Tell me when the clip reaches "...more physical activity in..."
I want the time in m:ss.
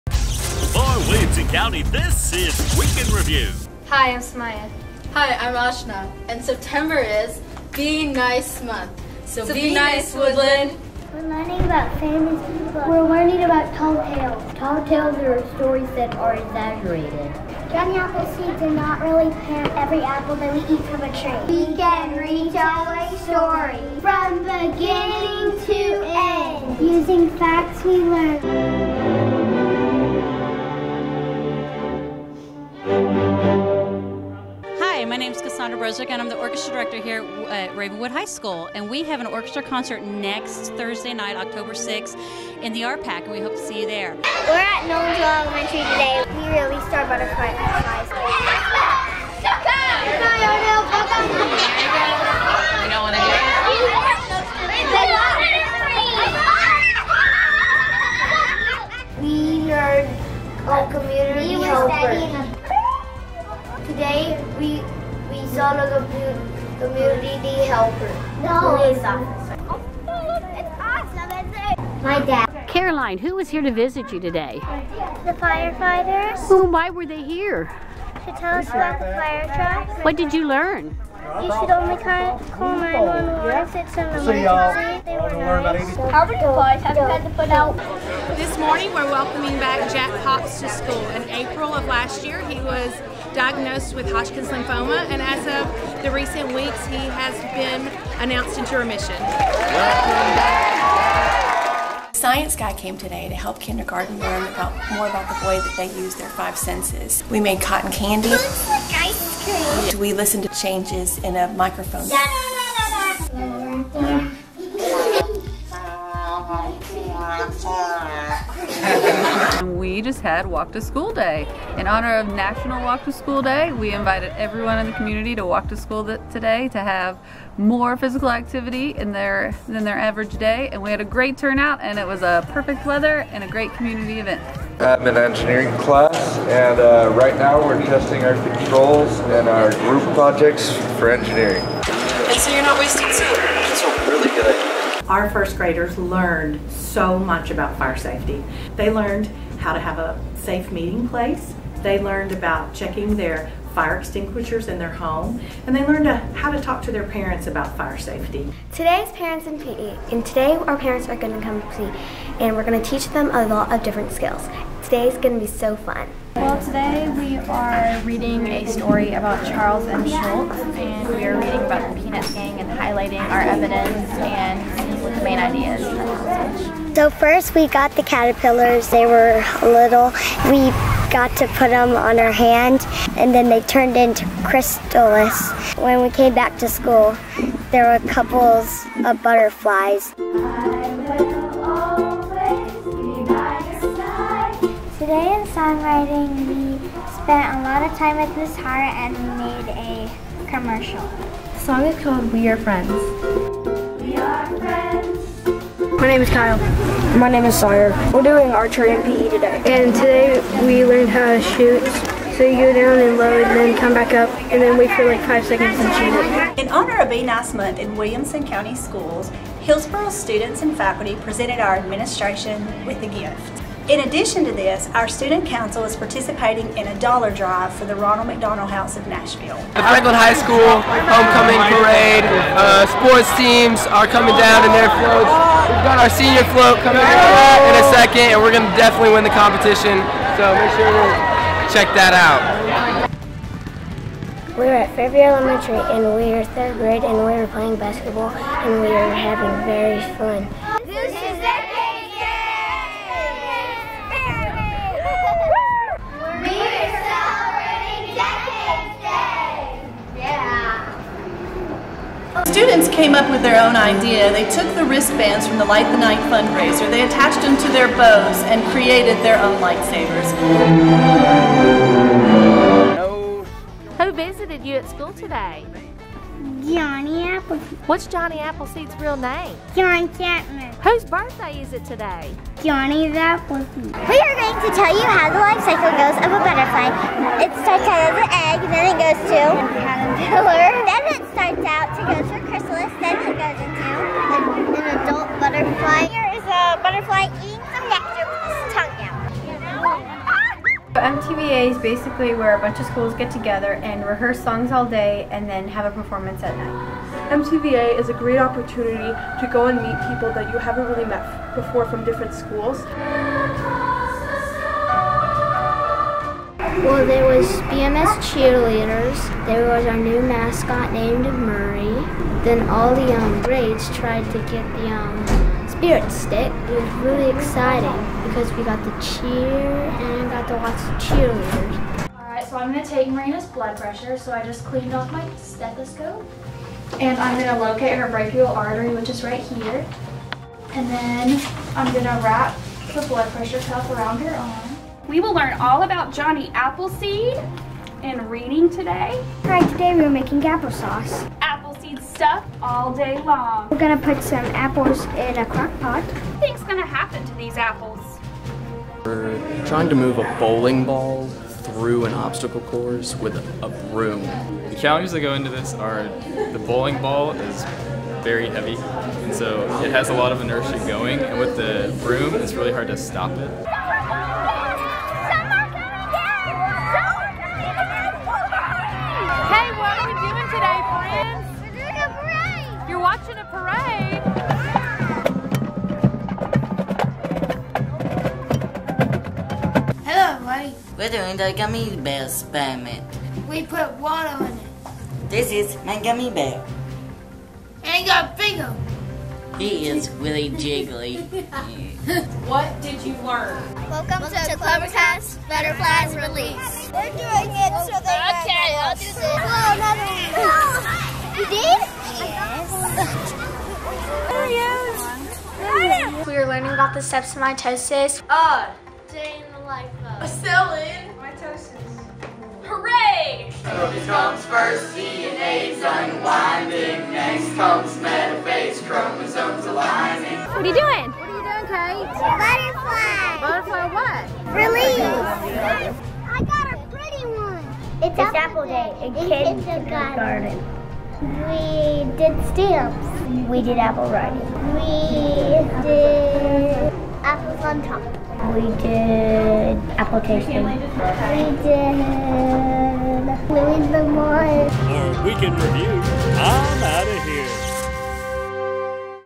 2:07.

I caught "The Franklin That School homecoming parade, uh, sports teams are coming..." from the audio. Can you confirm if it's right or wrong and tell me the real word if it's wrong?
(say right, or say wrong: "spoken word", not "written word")
wrong: "High", not "That".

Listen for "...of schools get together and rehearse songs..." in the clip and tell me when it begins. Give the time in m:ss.
5:02.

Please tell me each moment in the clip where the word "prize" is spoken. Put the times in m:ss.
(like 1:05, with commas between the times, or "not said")
not said.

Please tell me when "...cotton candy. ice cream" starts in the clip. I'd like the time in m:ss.
1:47.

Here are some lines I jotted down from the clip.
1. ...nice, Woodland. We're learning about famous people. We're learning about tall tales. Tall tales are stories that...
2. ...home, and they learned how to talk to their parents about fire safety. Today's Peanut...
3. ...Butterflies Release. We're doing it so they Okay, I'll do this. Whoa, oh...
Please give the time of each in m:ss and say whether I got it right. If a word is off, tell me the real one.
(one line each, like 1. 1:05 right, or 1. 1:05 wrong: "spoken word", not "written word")
1. 0:09 right
2. 2:34 wrong: "Parents", not "Peanut"
3. 6:45 right.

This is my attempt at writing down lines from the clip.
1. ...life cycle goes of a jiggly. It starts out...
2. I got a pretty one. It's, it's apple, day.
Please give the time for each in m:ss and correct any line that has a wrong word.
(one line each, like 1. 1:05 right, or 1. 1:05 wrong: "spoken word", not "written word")
1. 4:45 wrong: "butterfly", not "jiggly"
2. 7:16 right.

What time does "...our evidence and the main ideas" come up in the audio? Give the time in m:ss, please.
2:53.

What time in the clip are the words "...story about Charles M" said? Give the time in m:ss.
2:48.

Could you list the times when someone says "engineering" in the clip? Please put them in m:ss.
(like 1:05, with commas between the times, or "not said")
2:15, 2:21.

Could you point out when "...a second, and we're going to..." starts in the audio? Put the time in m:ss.
3:57.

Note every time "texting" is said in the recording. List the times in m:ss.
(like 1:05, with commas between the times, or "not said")
not said.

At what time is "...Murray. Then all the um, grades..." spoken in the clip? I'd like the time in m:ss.
5:21.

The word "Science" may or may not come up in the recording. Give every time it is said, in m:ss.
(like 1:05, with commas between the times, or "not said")
1:42.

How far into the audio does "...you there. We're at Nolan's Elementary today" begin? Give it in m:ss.
0:43.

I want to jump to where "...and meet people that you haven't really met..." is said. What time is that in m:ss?
5:09.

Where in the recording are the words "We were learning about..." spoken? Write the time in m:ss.
6:56.